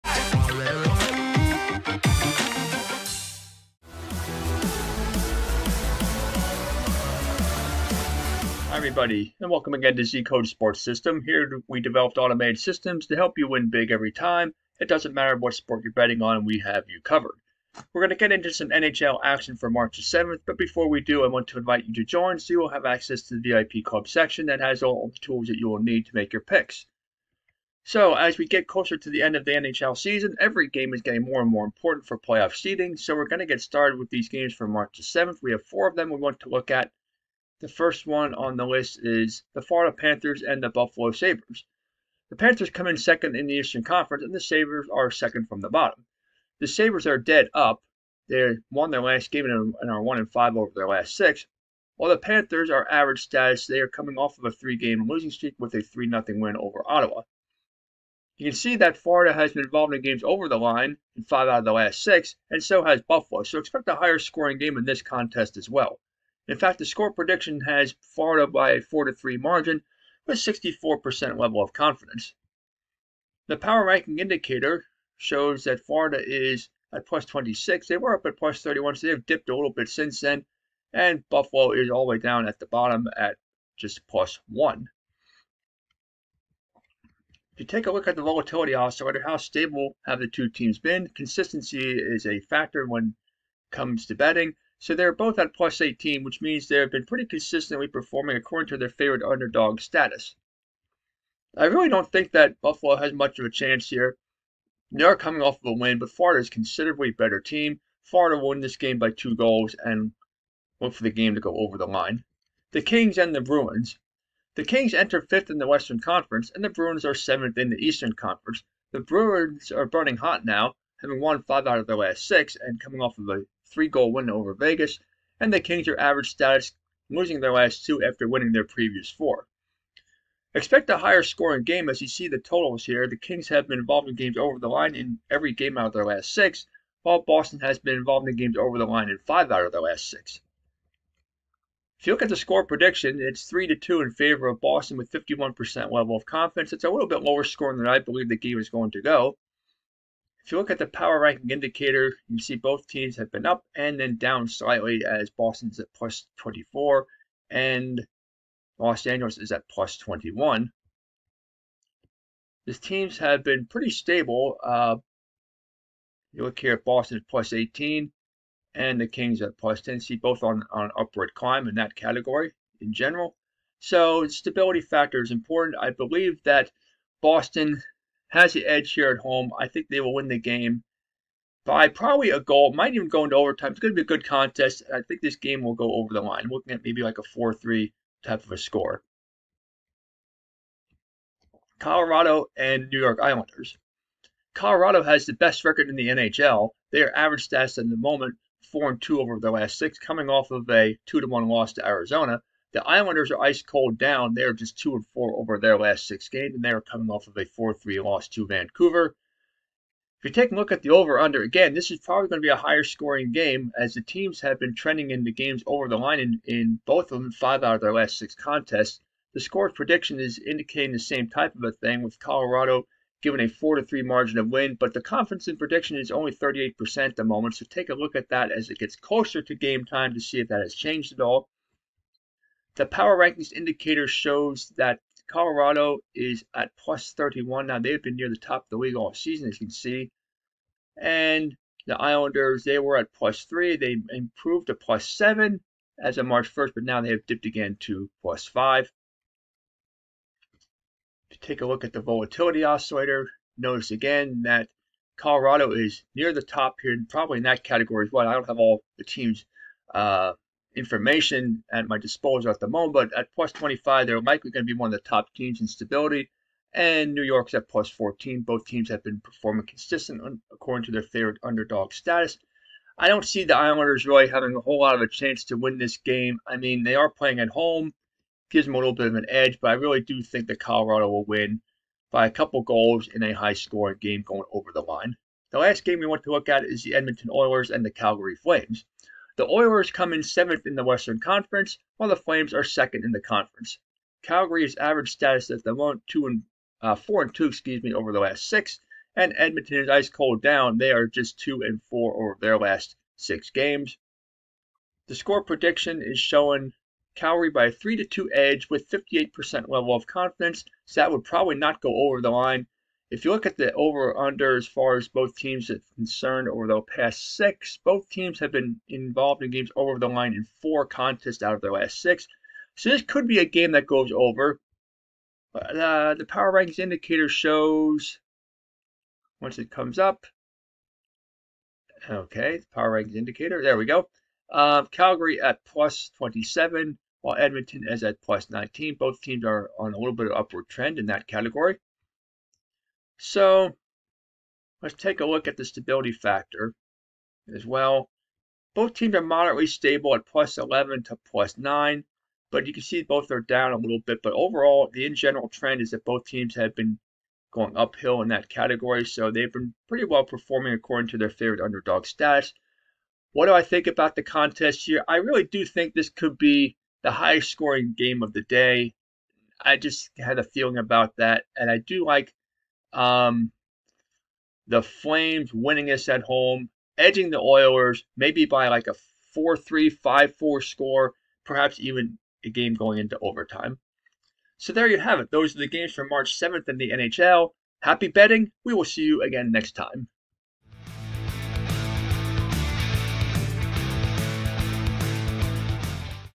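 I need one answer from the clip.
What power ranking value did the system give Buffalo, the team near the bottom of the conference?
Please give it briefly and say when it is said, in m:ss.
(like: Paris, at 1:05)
+1, at 1:24.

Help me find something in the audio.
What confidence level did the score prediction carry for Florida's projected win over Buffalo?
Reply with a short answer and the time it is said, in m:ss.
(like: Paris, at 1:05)
64%, at 1:10.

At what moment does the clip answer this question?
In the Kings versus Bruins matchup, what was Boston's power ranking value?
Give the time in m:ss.
2:35.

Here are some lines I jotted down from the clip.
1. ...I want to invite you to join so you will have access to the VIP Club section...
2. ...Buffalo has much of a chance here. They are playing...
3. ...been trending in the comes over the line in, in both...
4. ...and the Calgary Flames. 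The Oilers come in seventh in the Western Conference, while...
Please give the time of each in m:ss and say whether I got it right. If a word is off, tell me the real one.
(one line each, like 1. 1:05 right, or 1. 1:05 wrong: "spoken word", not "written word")
1. 0:21 right
2. 1:42 wrong: "coming", not "playing"
3. 3:34 wrong: "games", not "comes"
4. 4:47 right.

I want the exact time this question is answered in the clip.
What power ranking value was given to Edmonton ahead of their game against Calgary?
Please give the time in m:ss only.
5:38.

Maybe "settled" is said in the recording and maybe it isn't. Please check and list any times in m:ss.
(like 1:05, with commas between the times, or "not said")
not said.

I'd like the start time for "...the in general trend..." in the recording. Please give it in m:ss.
5:54.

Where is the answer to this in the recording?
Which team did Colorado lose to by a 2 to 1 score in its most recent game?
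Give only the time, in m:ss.
3:21.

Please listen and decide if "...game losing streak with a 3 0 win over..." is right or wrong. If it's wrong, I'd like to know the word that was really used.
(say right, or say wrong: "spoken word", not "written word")
right.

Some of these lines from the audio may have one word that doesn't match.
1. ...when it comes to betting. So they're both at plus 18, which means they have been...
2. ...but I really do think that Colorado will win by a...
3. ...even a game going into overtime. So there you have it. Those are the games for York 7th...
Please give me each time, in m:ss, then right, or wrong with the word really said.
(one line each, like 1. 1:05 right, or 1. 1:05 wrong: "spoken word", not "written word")
1. 1:32 right
2. 4:39 right
3. 6:21 wrong: "March", not "York".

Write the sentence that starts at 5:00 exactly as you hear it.
They are just two and four over their last six games.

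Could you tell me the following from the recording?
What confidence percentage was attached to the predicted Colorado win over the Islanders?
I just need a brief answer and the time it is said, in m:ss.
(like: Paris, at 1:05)
38%, at 3:46.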